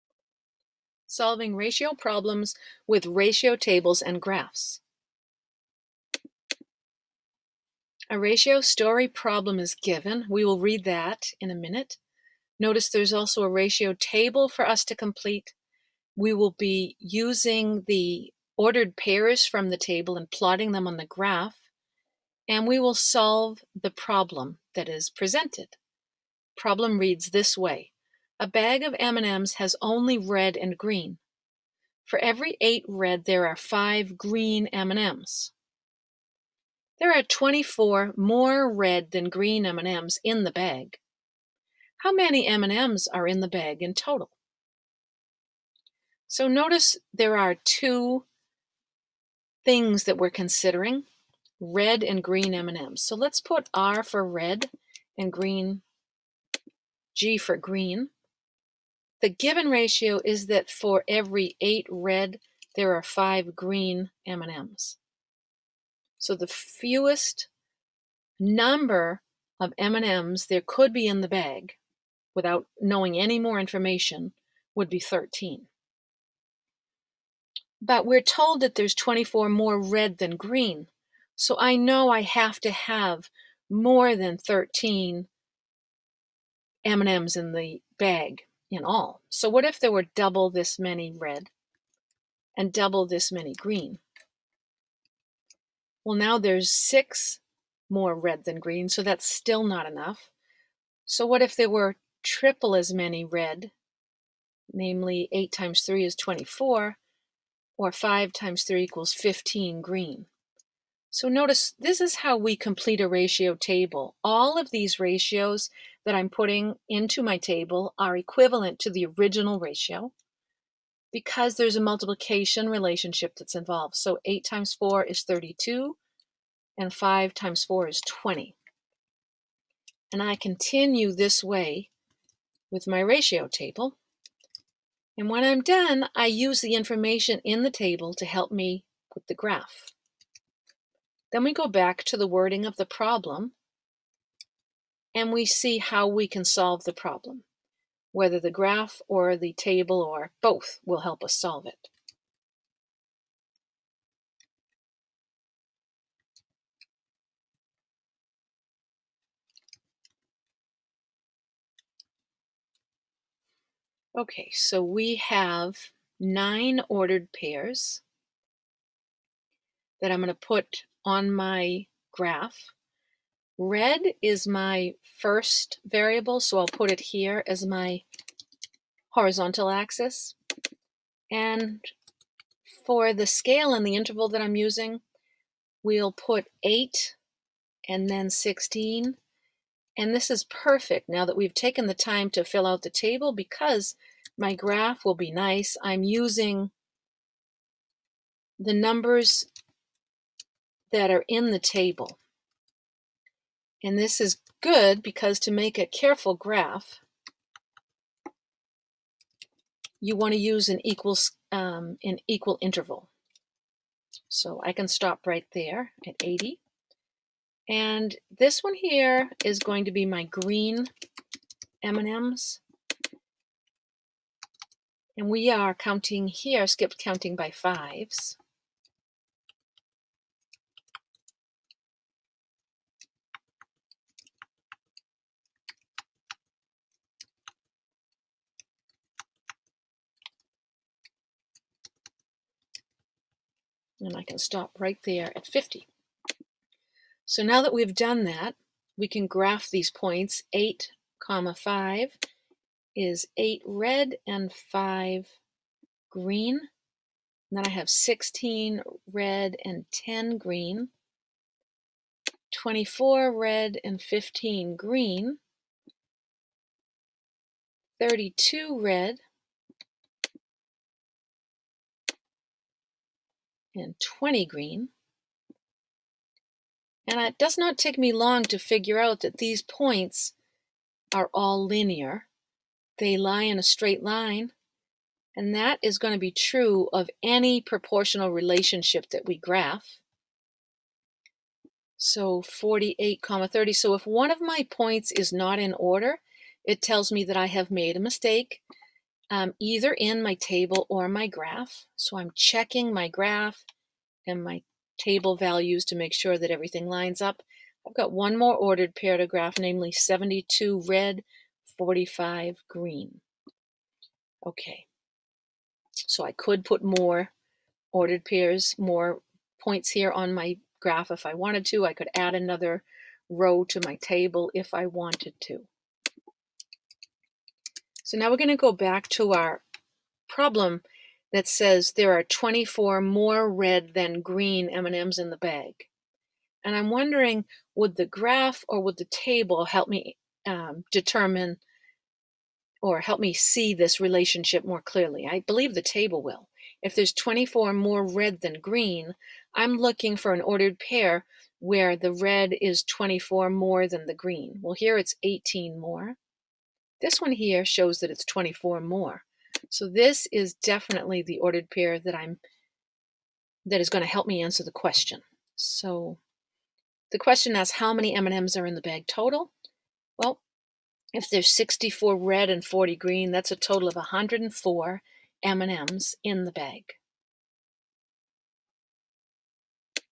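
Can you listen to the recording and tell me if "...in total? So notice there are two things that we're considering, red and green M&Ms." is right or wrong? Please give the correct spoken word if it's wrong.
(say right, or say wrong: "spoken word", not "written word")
right.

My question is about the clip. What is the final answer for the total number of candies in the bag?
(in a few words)
104.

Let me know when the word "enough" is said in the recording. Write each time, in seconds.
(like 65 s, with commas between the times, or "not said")
99 s.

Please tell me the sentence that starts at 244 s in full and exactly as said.
And I can stop right there at 50.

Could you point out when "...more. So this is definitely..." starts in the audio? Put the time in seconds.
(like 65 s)
358 s.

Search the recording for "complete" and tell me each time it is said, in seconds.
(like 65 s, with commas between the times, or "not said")
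14 s, 112 s.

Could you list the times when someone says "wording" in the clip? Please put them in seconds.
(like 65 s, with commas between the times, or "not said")
142 s.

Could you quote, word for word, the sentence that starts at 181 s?
And for the scale and the interval that I'm using, we'll put 8 and then 16.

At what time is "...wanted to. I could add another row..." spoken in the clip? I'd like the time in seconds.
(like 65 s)
321 s.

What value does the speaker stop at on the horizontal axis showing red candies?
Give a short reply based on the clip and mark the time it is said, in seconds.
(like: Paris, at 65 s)
80, at 216 s.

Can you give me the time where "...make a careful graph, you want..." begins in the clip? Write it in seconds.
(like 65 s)
205 s.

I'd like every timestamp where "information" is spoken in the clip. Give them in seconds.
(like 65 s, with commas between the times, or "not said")
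73 s, 136 s.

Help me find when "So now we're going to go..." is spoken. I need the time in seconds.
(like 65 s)
328 s.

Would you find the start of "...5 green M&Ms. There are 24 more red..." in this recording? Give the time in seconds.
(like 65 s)
33 s.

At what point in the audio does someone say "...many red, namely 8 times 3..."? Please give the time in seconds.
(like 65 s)
102 s.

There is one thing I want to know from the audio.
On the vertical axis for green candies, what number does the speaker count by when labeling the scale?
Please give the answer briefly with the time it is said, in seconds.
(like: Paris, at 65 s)
5, at 227 s.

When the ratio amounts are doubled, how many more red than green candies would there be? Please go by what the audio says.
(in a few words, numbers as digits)
6.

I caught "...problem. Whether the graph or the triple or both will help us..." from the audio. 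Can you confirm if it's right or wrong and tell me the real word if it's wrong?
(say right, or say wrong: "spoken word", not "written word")
wrong: "table", not "triple".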